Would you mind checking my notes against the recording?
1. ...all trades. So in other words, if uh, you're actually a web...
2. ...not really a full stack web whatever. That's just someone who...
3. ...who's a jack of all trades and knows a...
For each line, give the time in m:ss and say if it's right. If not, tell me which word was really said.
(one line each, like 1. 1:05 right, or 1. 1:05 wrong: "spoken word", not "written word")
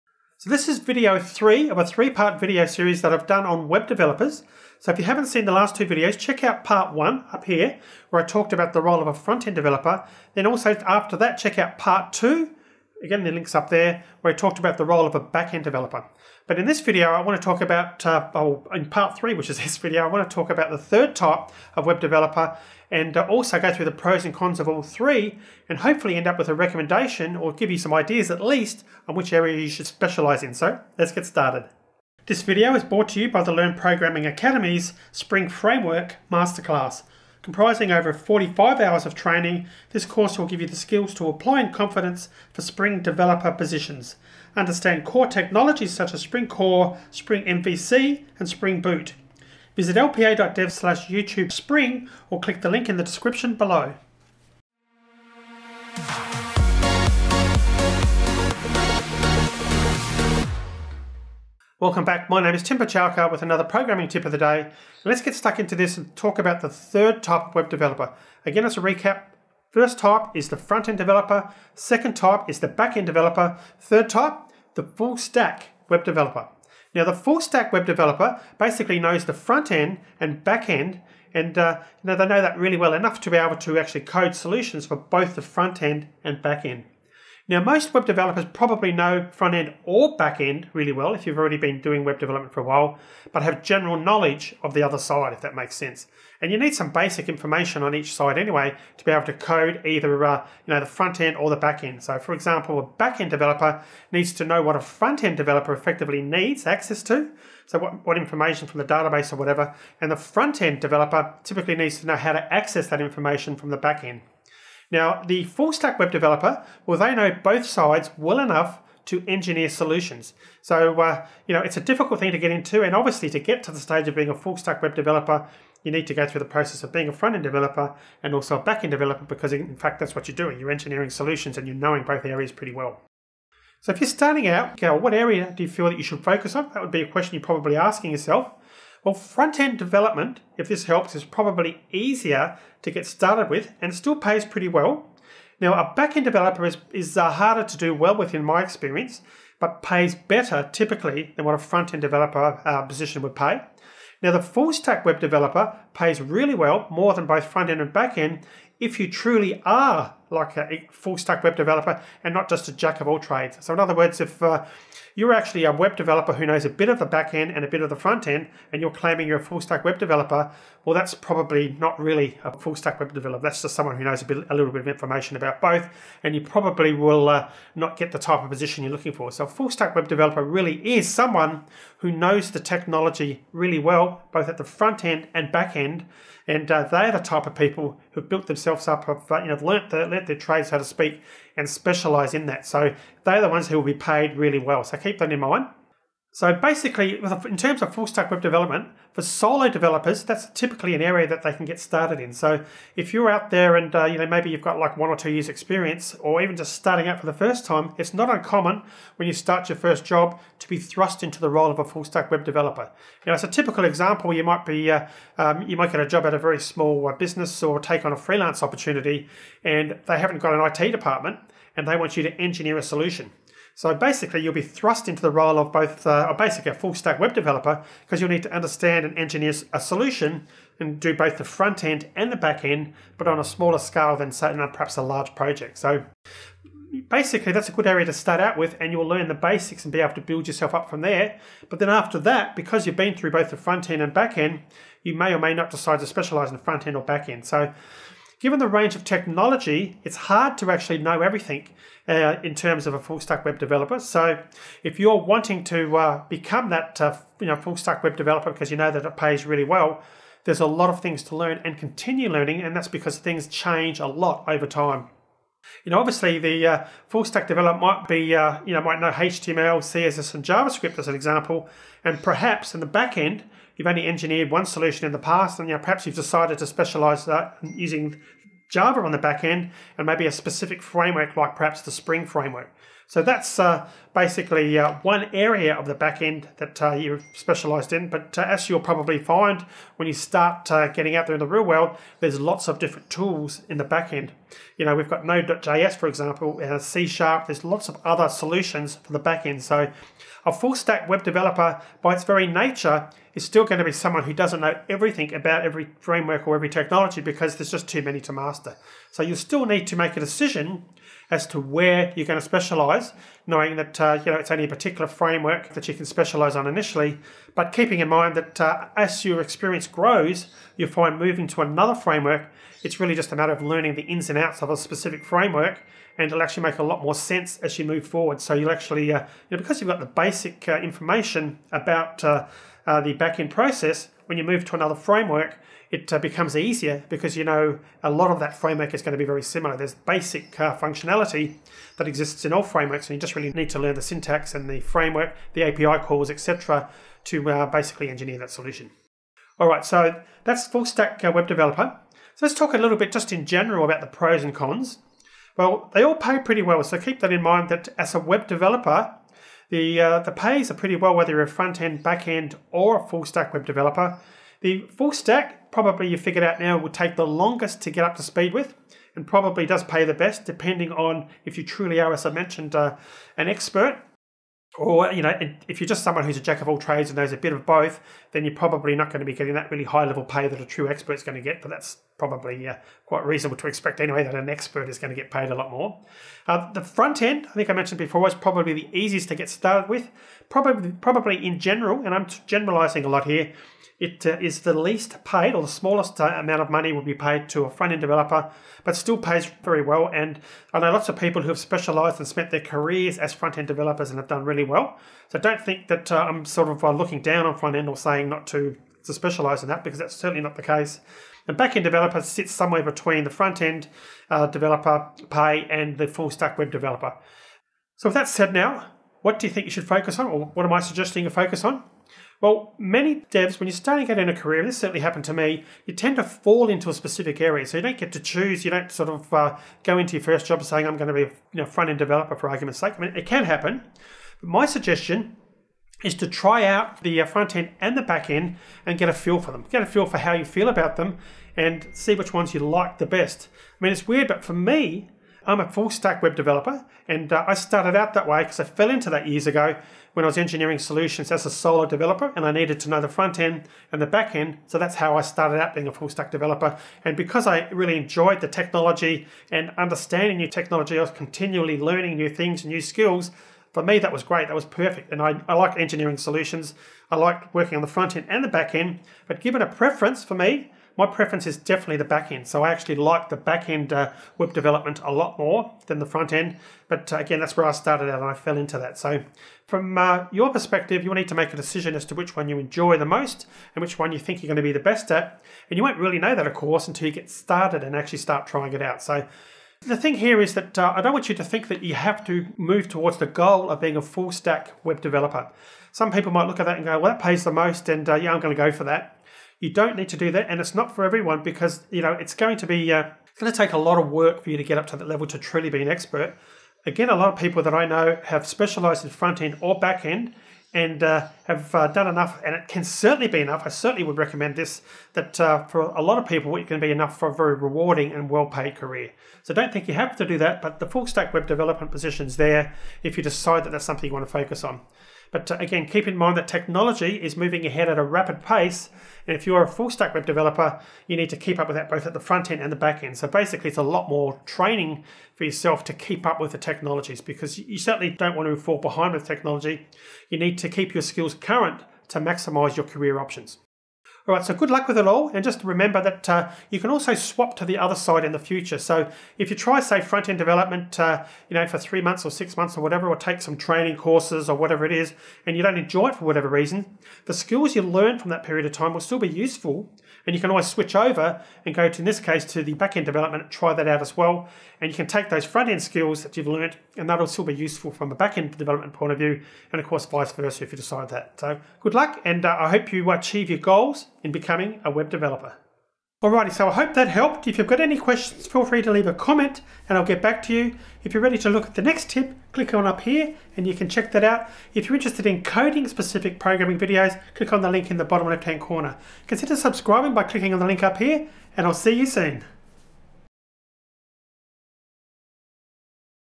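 1. 2:43 right
2. 2:51 wrong: "developer", not "whatever"
3. 6:16 right.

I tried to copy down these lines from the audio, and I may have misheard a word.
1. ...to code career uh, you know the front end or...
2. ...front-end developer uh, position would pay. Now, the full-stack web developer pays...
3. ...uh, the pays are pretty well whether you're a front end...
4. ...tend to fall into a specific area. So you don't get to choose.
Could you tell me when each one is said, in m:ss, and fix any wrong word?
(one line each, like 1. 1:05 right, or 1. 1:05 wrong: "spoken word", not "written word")
1. 1:39 wrong: "either", not "career"
2. 2:31 right
3. 5:59 right
4. 7:05 right.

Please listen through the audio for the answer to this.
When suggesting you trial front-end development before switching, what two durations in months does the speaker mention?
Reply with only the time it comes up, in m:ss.
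9:11.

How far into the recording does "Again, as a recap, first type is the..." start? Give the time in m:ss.
1:08.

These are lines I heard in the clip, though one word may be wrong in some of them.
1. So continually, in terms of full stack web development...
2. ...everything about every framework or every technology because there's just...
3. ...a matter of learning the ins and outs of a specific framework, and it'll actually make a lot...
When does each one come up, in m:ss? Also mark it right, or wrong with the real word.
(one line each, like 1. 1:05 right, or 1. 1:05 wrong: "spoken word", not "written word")
1. 3:16 wrong: "basically", not "continually"
2. 5:04 right
3. 5:23 right.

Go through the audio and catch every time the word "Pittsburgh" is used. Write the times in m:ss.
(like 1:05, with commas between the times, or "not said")
not said.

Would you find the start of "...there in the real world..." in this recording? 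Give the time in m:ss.
4:51.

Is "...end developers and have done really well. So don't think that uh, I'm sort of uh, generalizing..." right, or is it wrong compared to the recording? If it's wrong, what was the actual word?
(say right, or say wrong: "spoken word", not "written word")
wrong: "looking", not "generalizing".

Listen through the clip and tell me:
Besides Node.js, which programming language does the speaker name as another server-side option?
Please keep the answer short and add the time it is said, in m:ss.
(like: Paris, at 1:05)
C Sharp, at 4:56.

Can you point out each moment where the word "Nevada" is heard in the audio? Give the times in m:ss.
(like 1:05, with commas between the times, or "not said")
not said.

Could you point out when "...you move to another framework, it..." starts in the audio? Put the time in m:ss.
5:34.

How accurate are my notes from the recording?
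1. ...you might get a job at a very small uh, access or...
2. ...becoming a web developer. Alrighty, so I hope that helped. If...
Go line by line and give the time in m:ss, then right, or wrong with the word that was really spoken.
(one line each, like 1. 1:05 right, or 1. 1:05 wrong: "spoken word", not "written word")
1. 3:35 wrong: "business", not "access"
2. 9:34 right.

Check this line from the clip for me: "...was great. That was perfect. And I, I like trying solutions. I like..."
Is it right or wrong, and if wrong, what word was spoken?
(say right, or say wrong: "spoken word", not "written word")
wrong: "engineering", not "trying".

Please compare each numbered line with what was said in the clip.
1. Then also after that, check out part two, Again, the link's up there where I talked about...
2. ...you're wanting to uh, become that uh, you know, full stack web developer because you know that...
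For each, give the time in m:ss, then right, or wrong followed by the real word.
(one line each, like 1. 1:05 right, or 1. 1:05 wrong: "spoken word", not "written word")
1. 0:10 right
2. 4:14 right.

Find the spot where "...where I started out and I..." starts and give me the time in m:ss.
7:57.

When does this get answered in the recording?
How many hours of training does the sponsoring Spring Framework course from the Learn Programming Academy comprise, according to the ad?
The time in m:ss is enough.
0:37.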